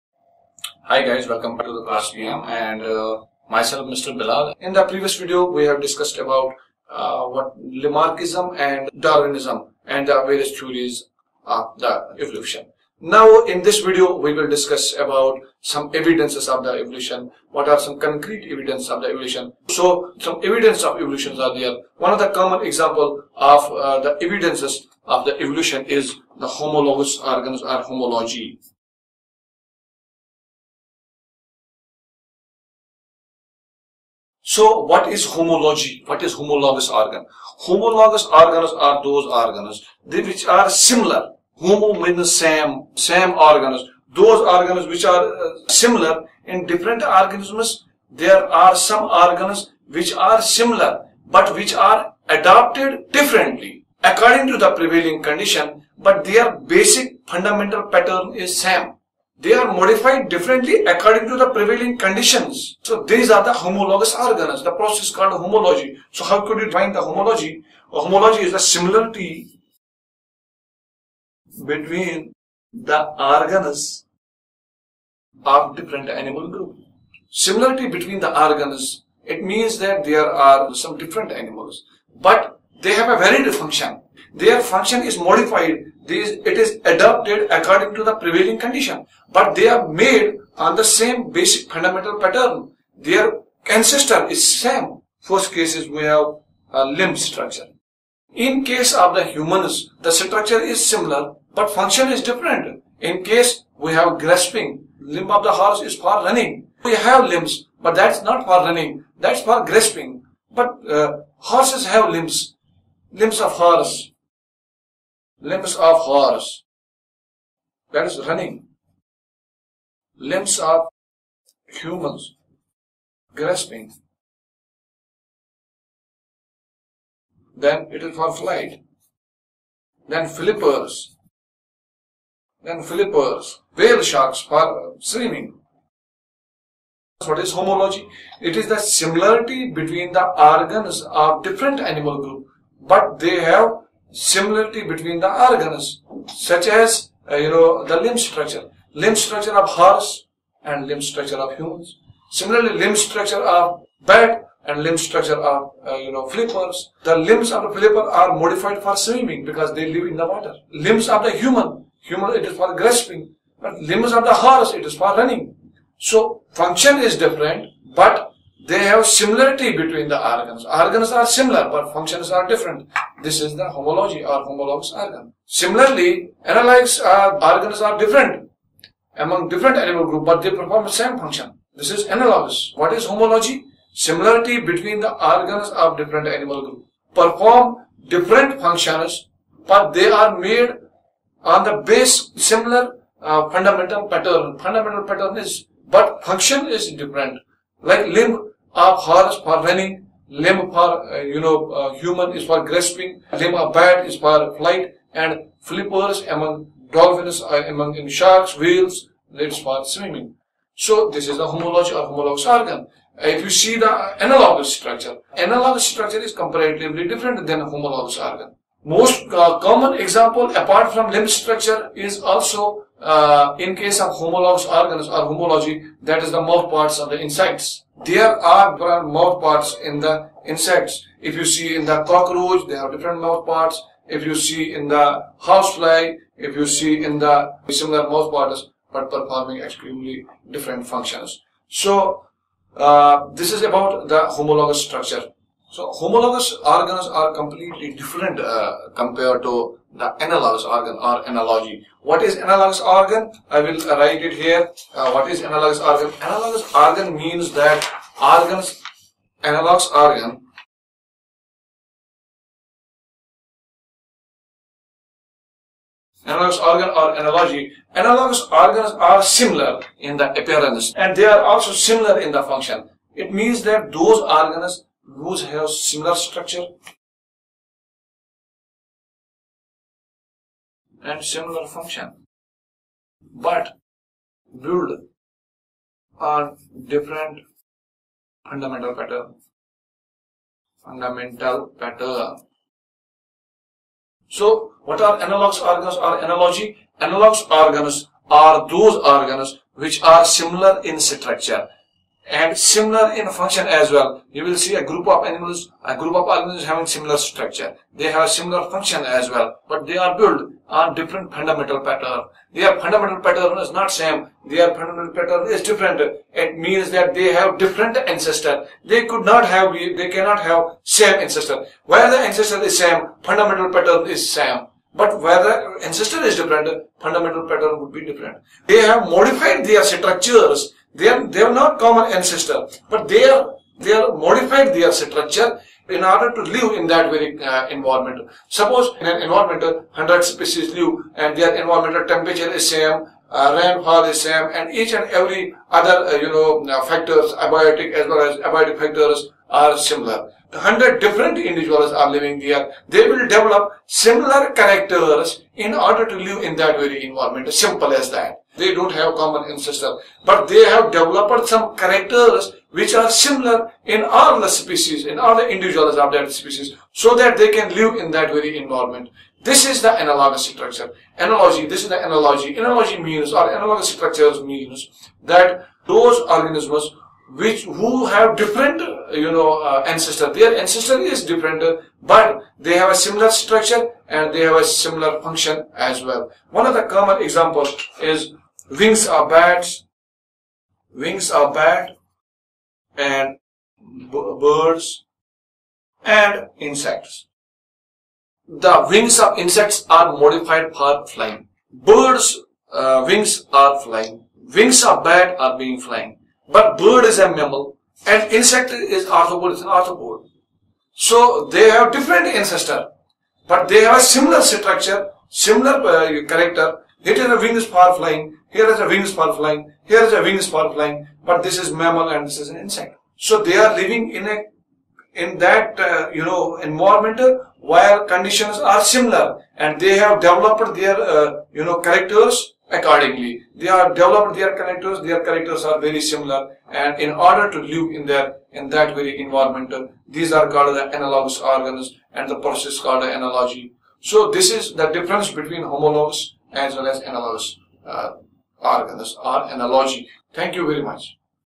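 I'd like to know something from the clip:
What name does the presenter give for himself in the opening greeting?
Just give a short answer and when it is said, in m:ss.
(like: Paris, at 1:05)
Mr. Bilal, at 0:03.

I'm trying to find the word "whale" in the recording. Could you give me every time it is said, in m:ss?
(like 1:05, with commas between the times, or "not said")
2:13, 3:28.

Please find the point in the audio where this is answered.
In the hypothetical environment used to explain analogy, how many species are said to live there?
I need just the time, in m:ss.
5:39.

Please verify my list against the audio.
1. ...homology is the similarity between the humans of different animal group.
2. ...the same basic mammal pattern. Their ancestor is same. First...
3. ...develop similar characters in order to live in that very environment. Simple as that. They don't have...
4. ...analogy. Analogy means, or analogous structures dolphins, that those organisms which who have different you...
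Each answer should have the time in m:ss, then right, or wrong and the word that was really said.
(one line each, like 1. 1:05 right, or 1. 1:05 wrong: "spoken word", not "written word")
1. 1:08 wrong: "organs", not "humans"
2. 1:30 wrong: "fundamental", not "mammal"
3. 5:53 right
4. 6:12 wrong: "means", not "dolphins".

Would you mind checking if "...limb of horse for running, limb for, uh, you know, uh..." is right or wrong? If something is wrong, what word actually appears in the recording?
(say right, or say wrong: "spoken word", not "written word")
right.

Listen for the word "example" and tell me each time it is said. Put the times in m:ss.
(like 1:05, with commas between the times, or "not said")
0:22, 3:40, 6:27.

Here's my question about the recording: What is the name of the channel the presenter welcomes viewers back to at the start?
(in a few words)
KlassPM.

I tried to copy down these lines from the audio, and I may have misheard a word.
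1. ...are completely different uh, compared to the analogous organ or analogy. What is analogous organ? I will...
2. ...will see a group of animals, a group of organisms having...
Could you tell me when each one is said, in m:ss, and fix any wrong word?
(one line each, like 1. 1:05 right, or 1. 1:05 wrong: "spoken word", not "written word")
1. 4:07 right
2. 5:04 right.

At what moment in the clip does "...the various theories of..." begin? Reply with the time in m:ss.
0:10.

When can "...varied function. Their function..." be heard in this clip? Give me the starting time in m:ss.
1:23.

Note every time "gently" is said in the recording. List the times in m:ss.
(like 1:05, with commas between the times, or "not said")
not said.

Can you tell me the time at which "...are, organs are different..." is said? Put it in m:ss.
2:56.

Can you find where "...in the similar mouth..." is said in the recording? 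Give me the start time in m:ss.
3:57.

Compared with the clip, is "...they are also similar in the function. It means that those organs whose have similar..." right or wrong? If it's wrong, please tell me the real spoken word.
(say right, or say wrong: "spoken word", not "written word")
right.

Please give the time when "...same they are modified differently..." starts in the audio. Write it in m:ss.
0:58.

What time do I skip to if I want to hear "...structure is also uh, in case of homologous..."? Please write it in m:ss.
3:41.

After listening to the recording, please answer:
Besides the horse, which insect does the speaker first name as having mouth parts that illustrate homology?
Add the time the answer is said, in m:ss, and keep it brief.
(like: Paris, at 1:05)
cockroach, at 3:52.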